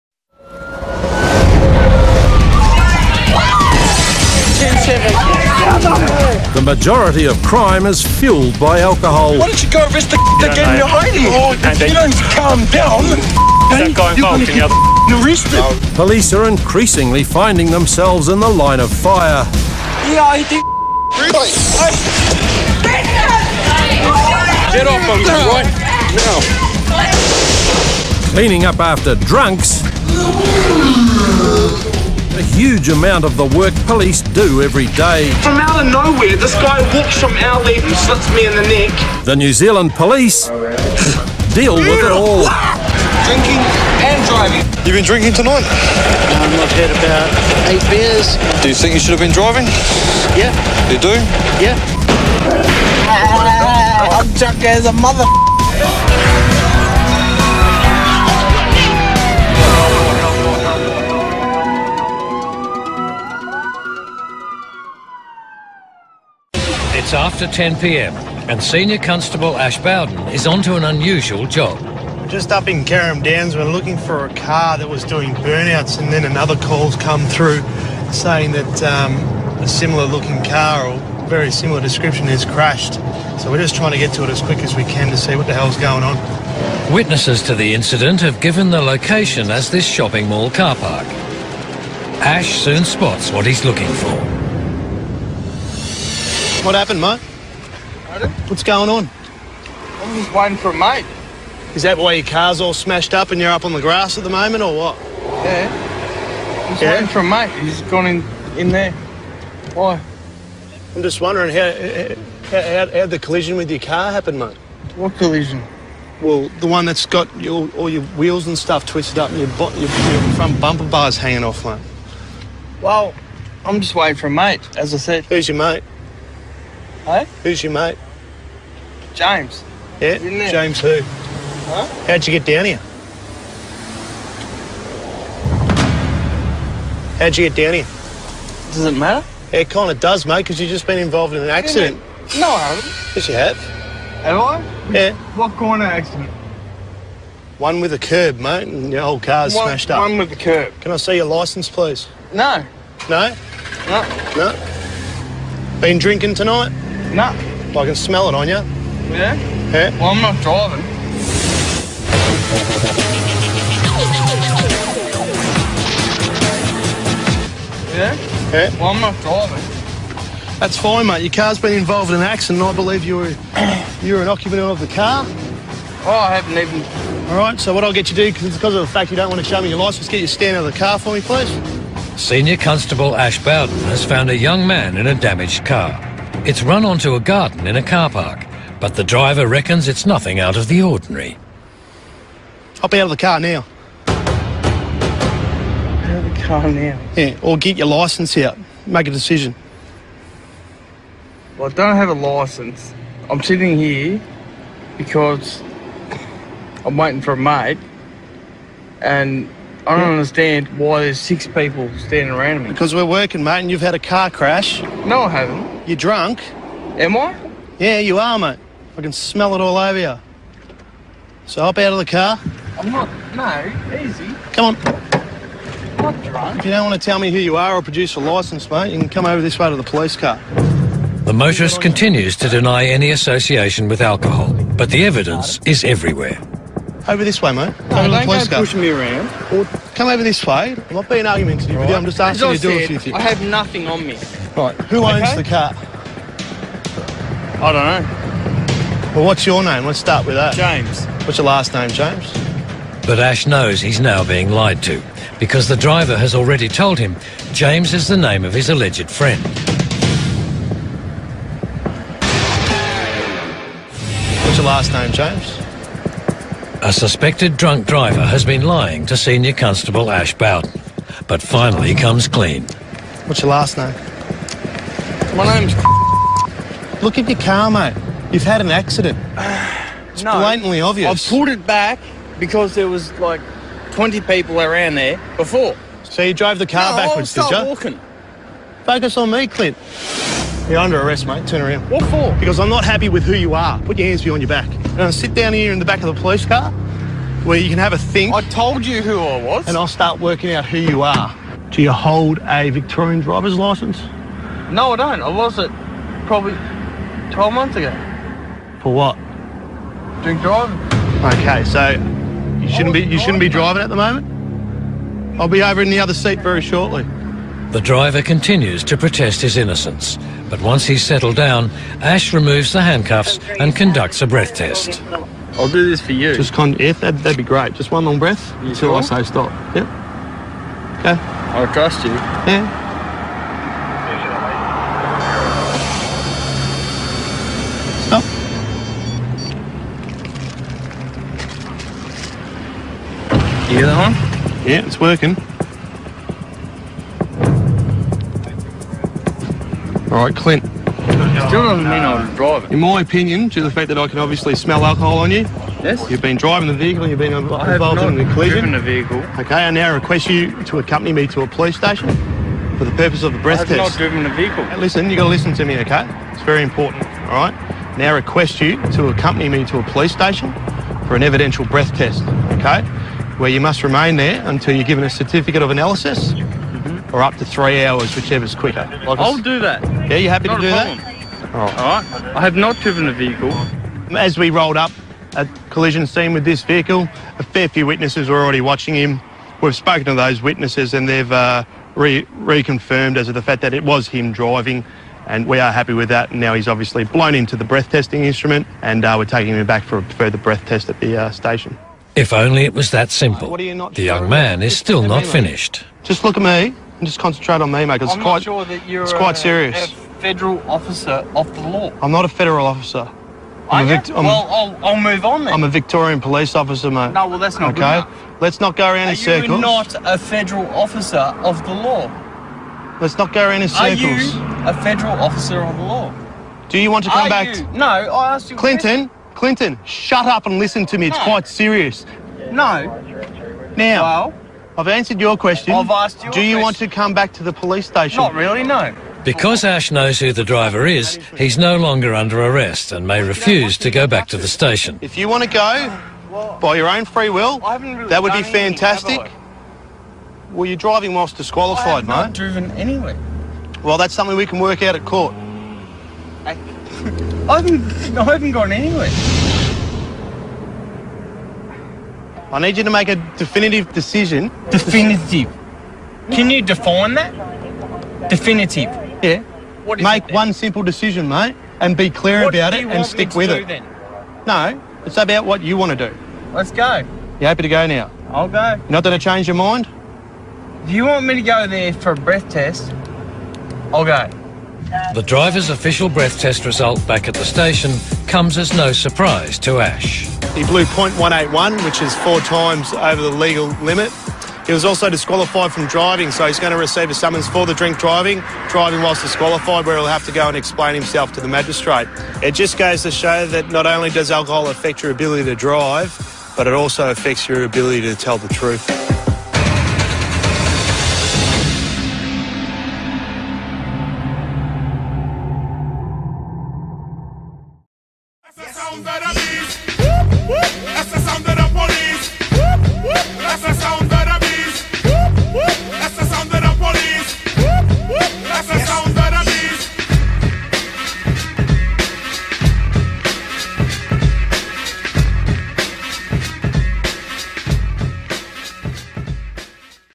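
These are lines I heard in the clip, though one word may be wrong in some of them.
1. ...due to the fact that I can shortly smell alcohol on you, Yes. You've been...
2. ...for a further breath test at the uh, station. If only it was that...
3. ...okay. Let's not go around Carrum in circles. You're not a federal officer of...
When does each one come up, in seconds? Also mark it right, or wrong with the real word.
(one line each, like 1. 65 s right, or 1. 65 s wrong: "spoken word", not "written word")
1. 353 s wrong: "obviously", not "shortly"
2. 399 s right
3. 417 s wrong: "Are", not "Carrum".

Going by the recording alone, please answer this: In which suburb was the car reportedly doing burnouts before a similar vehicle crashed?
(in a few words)
Carrum Downs.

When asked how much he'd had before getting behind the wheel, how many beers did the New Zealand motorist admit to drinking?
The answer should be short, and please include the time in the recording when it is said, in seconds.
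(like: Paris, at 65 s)
8, at 47 s.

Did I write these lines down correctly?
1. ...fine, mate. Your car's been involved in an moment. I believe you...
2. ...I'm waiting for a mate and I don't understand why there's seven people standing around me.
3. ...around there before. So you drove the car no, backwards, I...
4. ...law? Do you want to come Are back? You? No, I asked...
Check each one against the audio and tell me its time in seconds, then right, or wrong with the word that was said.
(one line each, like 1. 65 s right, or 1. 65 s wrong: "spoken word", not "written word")
1. 170 s wrong: "accident", not "moment"
2. 206 s wrong: "six", not "seven"
3. 284 s right
4. 425 s right.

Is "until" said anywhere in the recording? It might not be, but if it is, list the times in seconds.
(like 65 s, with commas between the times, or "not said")
328 s, 374 s.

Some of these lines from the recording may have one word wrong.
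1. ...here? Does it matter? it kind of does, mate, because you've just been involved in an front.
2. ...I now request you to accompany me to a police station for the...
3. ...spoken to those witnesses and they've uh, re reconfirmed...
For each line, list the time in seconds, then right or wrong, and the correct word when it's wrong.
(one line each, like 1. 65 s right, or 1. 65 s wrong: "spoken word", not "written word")
1. 137 s wrong: "accident", not "front"
2. 359 s right
3. 389 s right.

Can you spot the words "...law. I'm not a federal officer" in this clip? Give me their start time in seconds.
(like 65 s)
411 s.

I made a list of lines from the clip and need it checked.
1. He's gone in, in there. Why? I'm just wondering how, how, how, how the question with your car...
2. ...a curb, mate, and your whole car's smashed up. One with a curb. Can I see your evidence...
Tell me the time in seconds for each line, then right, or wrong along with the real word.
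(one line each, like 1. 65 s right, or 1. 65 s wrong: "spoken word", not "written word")
1. 107 s wrong: "collision", not "question"
2. 147 s wrong: "licence", not "evidence".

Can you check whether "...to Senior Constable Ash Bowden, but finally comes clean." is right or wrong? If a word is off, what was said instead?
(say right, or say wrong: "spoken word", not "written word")
right.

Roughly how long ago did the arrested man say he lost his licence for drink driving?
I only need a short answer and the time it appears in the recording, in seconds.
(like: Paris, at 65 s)
12 months, at 307 s.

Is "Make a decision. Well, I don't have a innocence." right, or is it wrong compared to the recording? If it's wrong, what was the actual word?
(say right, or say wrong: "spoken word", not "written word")
wrong: "licence", not "innocence".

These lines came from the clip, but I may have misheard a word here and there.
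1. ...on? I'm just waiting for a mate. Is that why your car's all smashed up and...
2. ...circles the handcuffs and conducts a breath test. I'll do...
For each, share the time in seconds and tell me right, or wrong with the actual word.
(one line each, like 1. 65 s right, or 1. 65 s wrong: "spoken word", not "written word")
1. 98 s right
2. 322 s wrong: "removes", not "circles".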